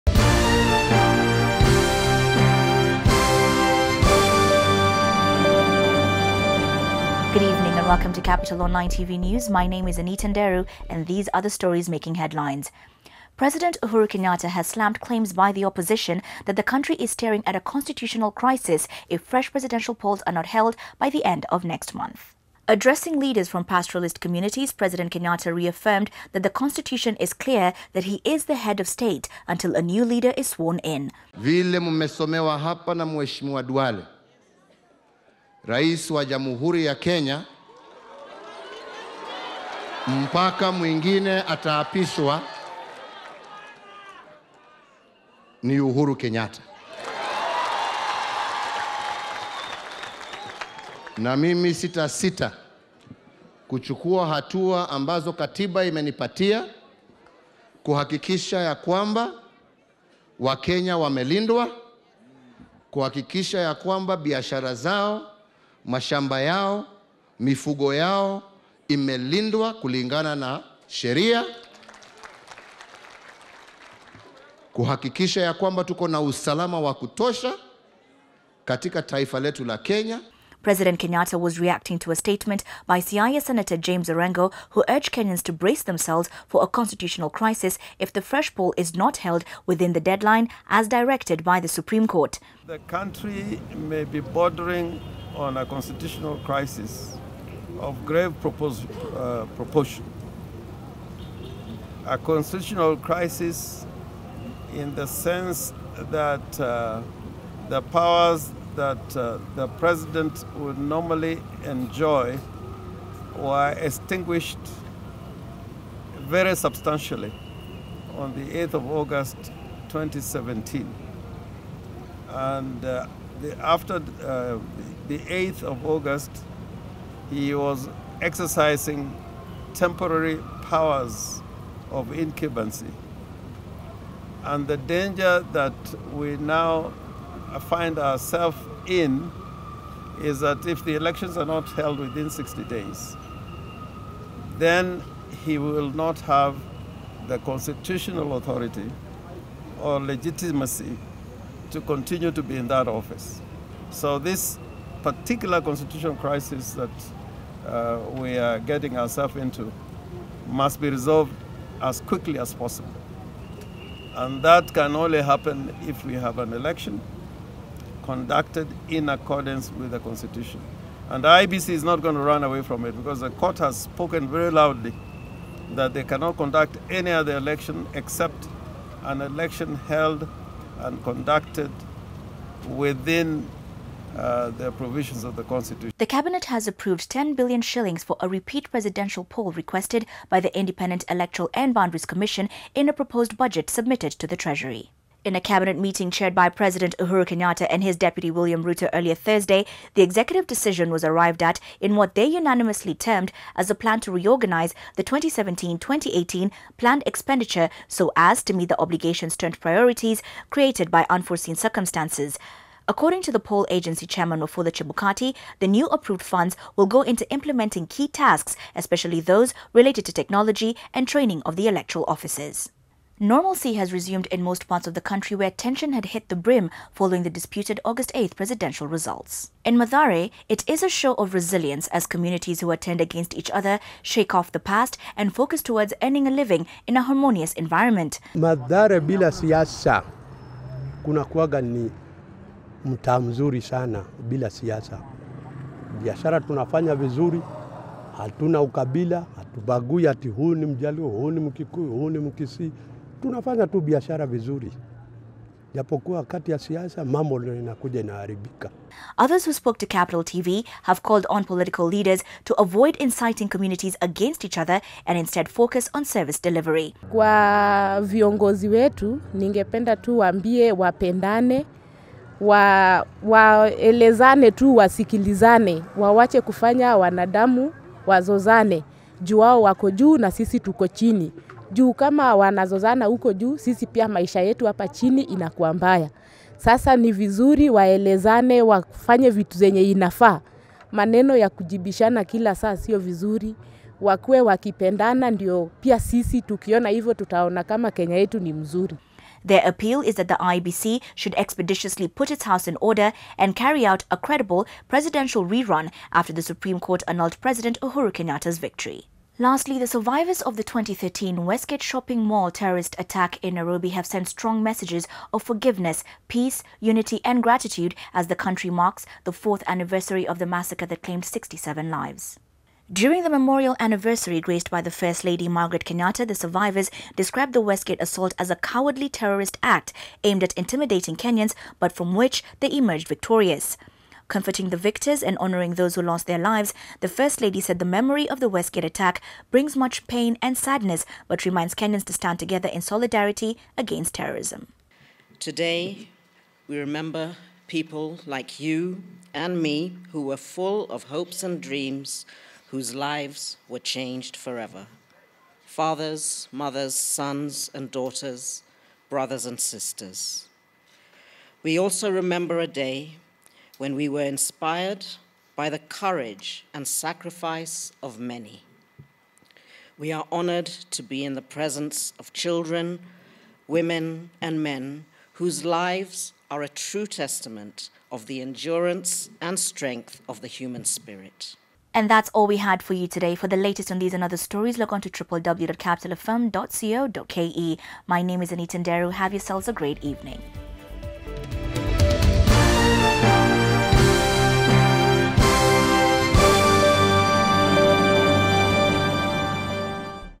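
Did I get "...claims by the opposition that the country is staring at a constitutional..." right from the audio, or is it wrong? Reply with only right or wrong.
right.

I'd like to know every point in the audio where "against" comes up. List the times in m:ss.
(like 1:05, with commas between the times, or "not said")
3:52, 4:24, 5:43.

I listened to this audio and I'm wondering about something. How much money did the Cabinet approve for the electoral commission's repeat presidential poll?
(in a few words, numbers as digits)
10 billion shillings.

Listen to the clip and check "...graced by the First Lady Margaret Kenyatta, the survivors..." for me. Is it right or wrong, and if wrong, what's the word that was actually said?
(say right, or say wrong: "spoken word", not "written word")
right.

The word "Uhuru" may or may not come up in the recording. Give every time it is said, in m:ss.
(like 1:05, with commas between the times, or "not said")
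0:13, 0:45, 3:16, 5:07.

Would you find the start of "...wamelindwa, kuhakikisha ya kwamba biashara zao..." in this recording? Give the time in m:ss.
1:00.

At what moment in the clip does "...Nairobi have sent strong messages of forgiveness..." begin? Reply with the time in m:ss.
5:13.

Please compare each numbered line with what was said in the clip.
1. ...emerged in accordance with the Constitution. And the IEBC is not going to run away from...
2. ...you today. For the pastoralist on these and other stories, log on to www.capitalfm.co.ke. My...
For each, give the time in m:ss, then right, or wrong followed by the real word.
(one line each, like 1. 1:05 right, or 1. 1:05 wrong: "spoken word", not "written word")
1. 2:48 wrong: "conducted", not "emerged"
2. 6:22 wrong: "latest", not "pastoralist".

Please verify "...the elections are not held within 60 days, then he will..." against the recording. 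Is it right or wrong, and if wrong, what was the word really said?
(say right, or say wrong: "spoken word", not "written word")
right.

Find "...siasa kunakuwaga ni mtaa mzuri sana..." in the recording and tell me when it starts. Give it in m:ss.
3:59.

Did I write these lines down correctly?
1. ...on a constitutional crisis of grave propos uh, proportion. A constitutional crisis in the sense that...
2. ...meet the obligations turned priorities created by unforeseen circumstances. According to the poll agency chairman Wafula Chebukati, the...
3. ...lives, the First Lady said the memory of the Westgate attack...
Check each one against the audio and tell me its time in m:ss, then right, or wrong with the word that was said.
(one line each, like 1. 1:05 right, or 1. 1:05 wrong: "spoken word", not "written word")
1. 1:35 right
2. 3:28 right
3. 5:36 right.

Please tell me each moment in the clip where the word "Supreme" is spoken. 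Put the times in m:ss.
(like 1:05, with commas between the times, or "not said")
1:31, 5:06.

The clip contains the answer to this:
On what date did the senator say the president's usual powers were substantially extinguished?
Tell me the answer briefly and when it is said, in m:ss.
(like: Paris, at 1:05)
8th of August 2017, at 1:58.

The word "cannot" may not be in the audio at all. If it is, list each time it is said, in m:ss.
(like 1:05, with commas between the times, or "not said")
2:56.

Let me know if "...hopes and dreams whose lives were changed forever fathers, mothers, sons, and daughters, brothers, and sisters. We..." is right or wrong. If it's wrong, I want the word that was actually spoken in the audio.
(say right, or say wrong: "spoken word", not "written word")
right.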